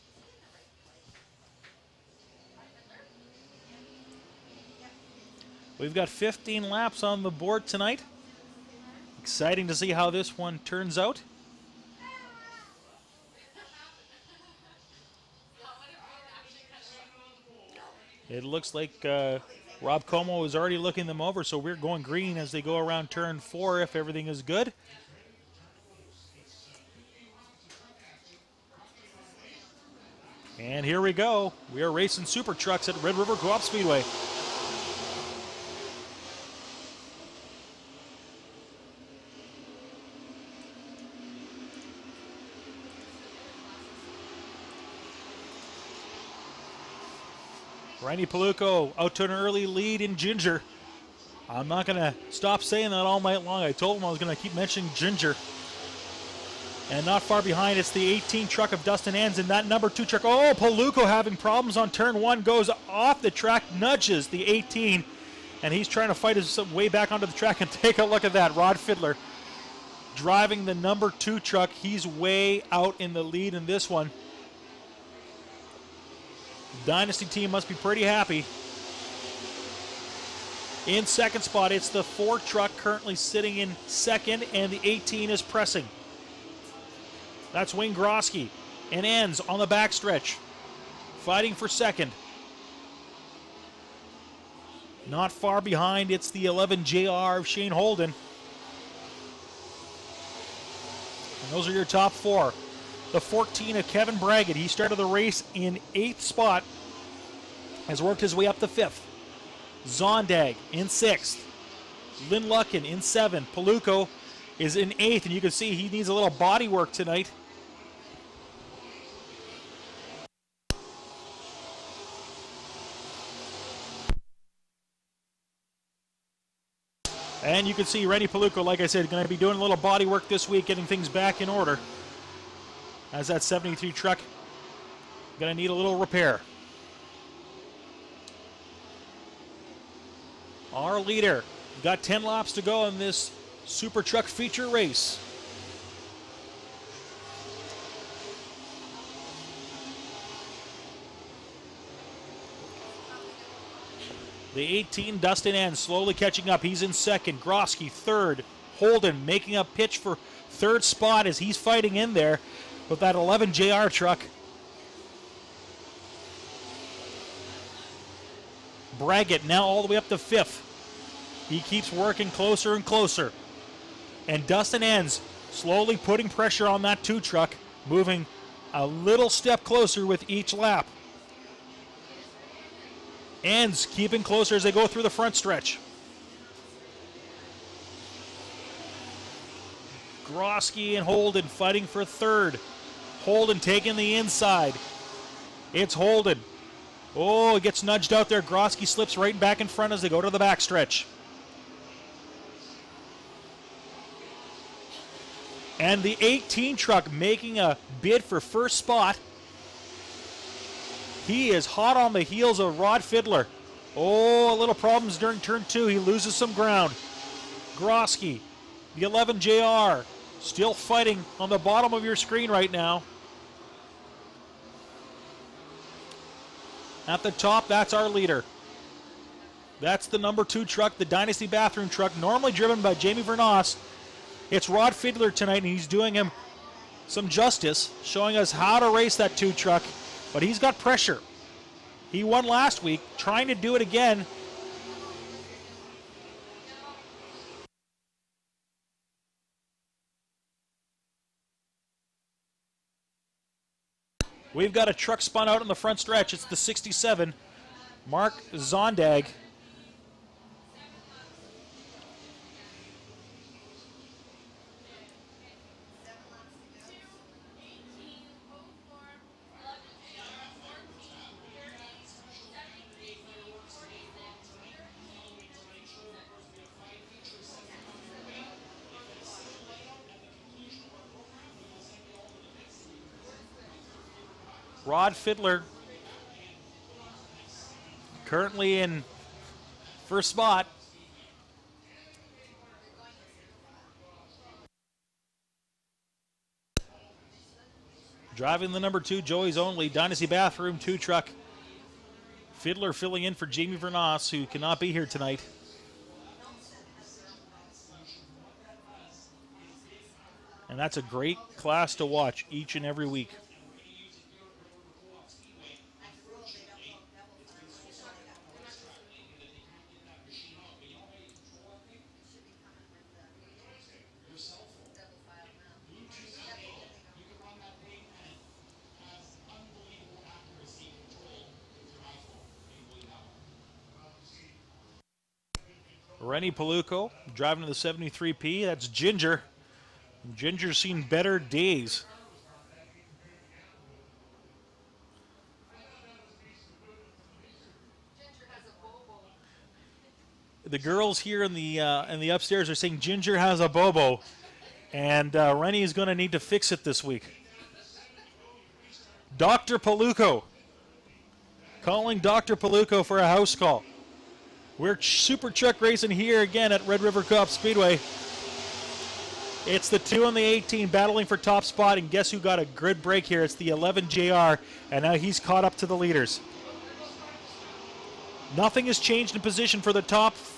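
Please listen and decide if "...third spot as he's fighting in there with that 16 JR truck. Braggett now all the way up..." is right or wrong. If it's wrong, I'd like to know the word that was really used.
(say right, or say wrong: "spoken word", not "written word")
wrong: "11", not "16".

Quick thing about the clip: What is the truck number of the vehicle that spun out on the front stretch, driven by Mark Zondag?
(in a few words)
67.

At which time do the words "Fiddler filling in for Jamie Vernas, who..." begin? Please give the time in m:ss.
5:02.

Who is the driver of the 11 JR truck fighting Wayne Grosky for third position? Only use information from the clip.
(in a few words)
Shane Holden.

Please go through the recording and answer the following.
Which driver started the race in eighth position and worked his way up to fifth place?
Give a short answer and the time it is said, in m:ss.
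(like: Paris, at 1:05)
Kevin Braggett, at 1:43.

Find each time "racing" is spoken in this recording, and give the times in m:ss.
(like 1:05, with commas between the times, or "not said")
0:31, 6:05.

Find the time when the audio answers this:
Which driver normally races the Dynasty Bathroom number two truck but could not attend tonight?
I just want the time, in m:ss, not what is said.
3:52.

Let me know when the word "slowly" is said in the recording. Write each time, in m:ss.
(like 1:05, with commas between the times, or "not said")
2:35, 2:55.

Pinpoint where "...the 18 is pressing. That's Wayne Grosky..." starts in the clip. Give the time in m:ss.
1:24.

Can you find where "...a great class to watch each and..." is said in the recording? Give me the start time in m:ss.
5:10.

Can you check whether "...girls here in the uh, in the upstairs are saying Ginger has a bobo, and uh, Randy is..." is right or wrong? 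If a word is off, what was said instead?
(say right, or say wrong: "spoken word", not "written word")
wrong: "Rennie", not "Randy".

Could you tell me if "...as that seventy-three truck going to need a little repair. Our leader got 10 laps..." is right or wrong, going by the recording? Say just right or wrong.
right.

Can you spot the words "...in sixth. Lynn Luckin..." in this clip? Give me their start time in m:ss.
1:50.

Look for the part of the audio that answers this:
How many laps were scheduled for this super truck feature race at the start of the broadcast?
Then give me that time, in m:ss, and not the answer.
0:06.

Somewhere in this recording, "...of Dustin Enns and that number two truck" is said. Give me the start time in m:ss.
0:58.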